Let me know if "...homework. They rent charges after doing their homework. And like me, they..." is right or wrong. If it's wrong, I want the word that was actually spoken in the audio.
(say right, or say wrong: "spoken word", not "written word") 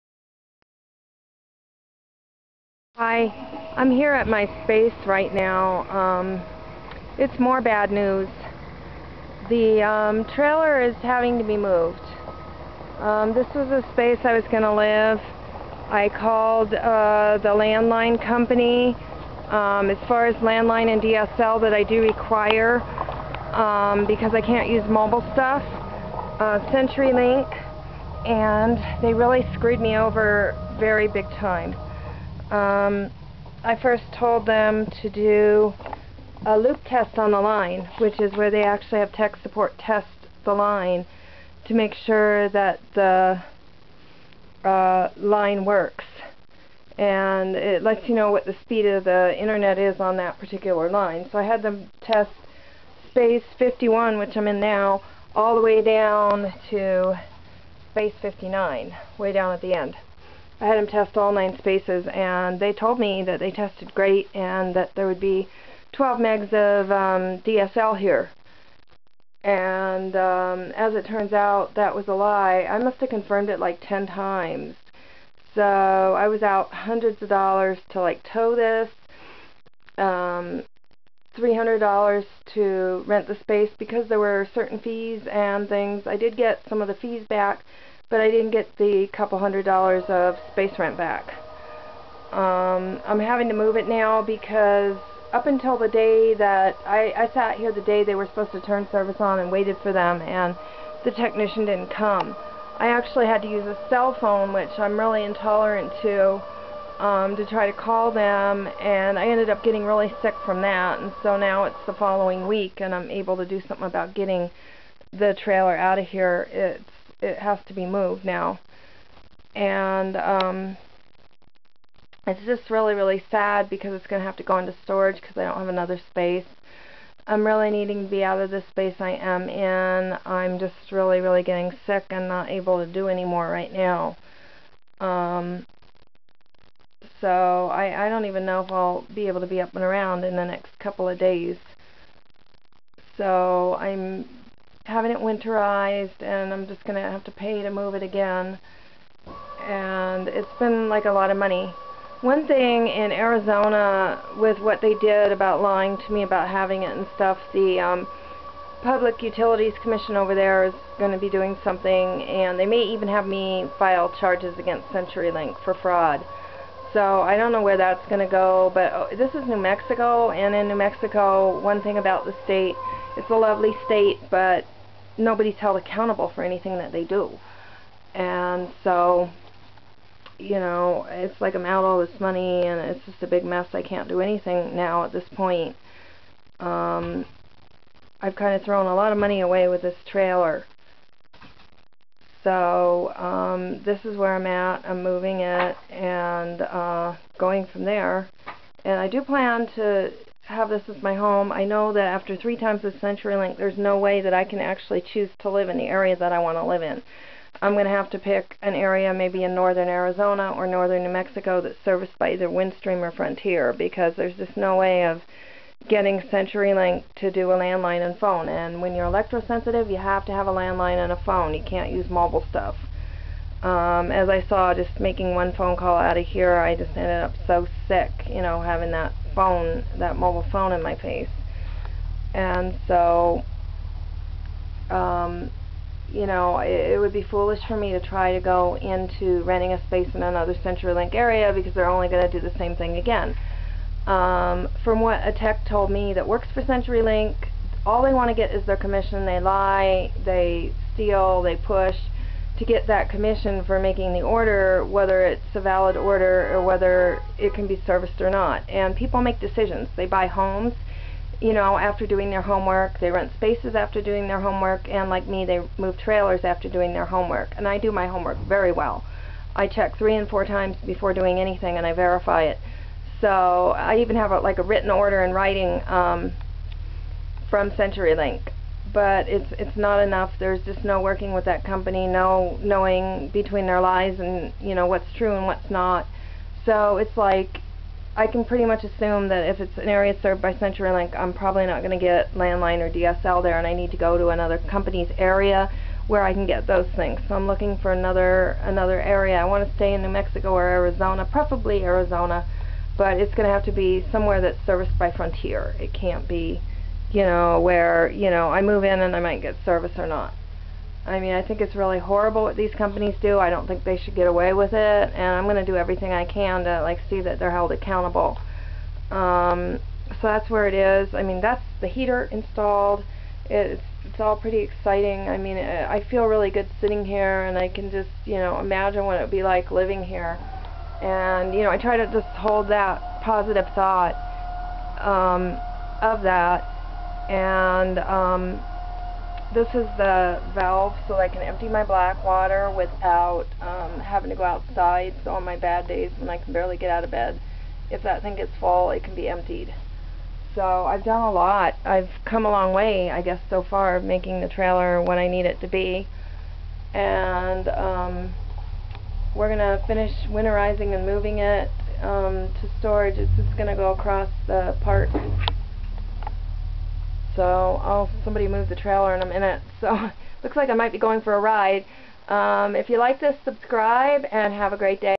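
wrong: "spaces", not "charges".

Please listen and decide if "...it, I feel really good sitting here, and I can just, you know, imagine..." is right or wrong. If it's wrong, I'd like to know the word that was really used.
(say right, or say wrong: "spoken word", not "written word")
right.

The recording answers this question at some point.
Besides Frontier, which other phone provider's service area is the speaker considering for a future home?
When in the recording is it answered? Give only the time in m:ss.
3:32.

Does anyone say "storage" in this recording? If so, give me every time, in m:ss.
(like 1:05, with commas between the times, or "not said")
2:04, 6:02.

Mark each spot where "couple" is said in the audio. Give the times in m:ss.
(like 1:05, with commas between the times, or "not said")
1:29, 2:20.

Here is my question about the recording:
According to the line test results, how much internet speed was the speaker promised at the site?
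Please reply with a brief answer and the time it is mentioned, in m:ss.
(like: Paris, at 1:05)
12 megs, at 1:05.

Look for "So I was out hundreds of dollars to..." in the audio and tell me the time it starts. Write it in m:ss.
1:15.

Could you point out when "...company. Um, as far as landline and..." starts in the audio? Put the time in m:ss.
0:18.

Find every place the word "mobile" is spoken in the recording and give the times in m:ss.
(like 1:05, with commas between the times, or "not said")
0:24, 3:42, 3:50.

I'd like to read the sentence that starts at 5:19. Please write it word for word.
Um, so that's where it is.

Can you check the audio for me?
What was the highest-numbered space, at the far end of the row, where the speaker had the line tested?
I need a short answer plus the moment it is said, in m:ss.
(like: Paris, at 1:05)
59, at 0:58.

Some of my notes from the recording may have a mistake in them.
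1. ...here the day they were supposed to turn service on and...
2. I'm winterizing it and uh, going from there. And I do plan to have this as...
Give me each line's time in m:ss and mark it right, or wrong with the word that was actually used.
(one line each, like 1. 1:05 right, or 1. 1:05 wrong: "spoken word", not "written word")
1. 1:37 right
2. 3:14 wrong: "moving", not "winterizing".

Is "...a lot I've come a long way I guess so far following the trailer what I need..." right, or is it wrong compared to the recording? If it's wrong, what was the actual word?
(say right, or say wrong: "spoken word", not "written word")
wrong: "making", not "following".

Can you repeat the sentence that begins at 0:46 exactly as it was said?
And it lets you know what the speed of the internet is on that particular line.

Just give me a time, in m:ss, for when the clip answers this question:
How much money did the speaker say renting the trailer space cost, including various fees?
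1:21.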